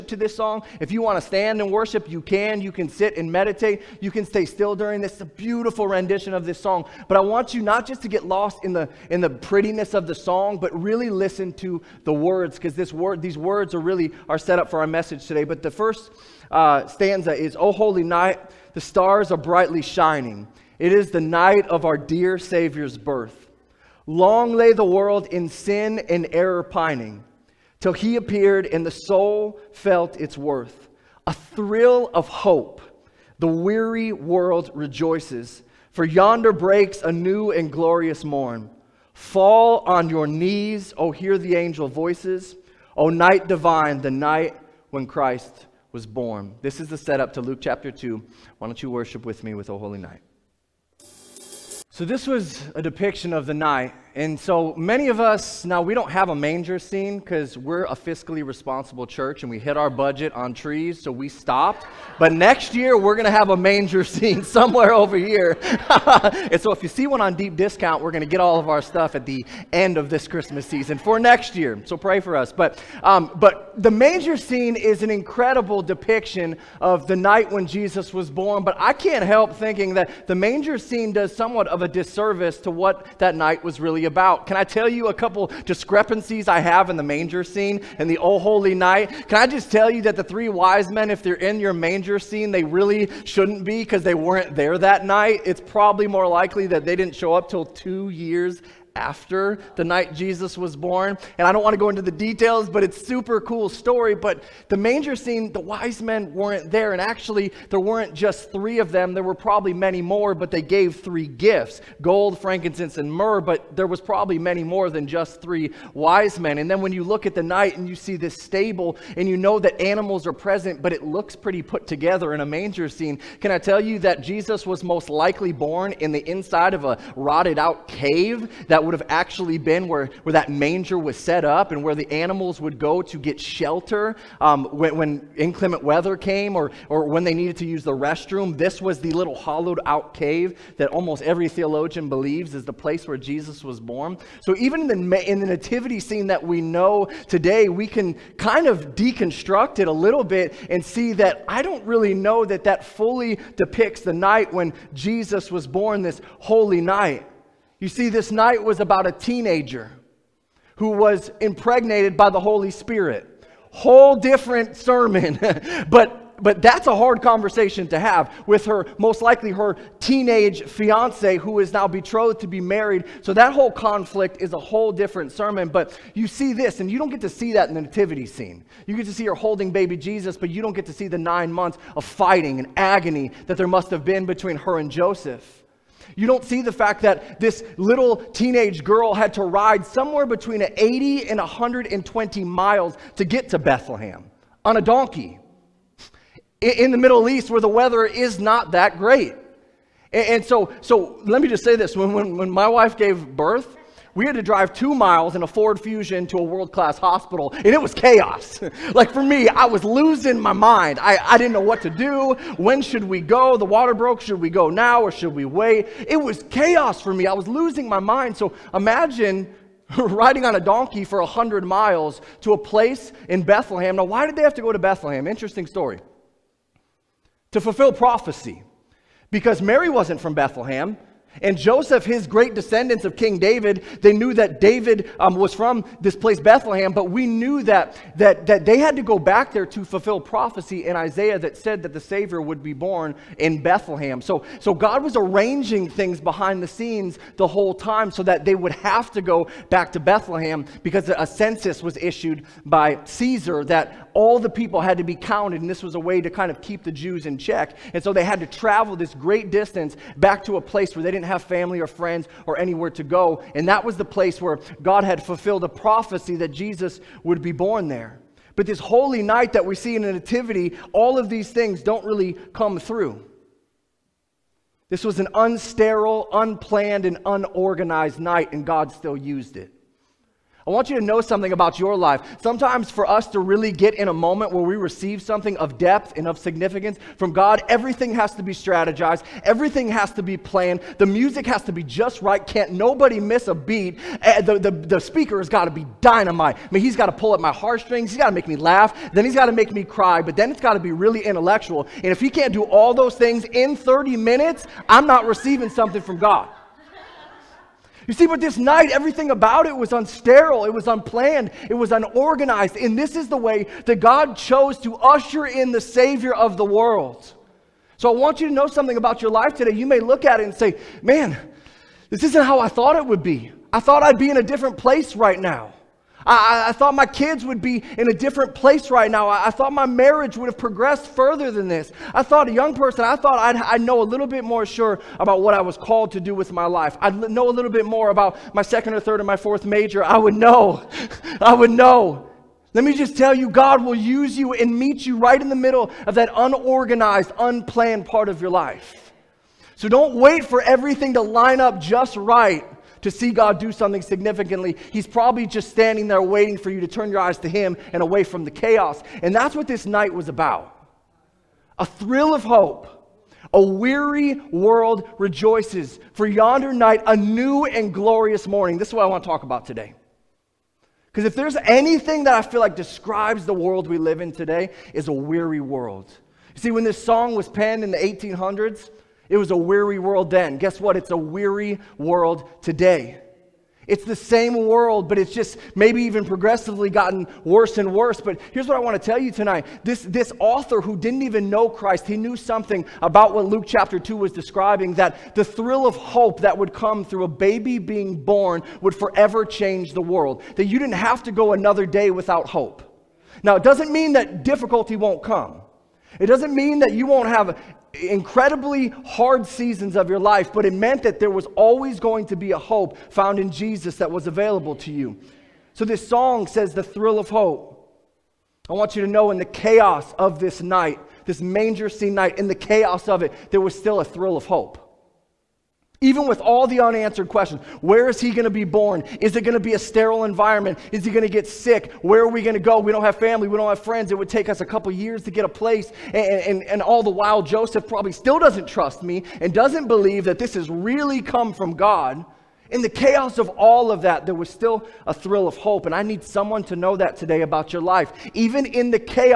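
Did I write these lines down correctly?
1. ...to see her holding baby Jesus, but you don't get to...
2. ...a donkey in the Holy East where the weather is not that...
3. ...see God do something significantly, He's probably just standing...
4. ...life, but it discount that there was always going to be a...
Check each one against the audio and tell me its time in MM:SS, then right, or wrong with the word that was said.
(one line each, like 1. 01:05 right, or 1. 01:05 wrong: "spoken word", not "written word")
1. 02:59 right
2. 03:14 wrong: "Middle", not "Holy"
3. 05:53 right
4. 06:50 wrong: "meant", not "discount".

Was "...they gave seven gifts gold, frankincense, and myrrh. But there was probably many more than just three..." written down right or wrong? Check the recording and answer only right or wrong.
wrong.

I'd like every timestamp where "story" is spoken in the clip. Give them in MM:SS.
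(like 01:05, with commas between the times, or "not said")
01:43, 03:45.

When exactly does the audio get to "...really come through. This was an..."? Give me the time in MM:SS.
04:32.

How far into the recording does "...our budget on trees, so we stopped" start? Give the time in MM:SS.
00:59.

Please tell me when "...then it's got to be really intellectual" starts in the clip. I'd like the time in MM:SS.
05:00.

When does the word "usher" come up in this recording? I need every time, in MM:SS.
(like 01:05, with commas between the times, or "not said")
05:14.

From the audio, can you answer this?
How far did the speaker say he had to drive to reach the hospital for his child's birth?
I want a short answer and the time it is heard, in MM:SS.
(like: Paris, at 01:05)
2 miles, at 03:24.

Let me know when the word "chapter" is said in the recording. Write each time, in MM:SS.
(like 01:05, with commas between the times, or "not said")
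00:47, 06:33.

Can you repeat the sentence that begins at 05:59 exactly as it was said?
And that's what this night was about a thrill of hope.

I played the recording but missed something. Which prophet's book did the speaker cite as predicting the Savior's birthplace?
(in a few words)
Isaiah.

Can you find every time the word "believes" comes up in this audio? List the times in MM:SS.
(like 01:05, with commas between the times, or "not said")
02:22, 07:19.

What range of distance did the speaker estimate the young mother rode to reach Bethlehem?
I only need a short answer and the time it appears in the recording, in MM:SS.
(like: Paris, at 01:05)
80 to 120 miles, at 03:10.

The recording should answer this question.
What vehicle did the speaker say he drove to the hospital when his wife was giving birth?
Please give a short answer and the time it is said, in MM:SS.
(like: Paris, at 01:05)
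Ford Fusion, at 03:25.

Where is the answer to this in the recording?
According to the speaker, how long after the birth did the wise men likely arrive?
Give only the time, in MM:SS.
01:37.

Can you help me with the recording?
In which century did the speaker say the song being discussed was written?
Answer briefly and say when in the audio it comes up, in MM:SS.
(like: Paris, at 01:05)
1800s, at 06:17.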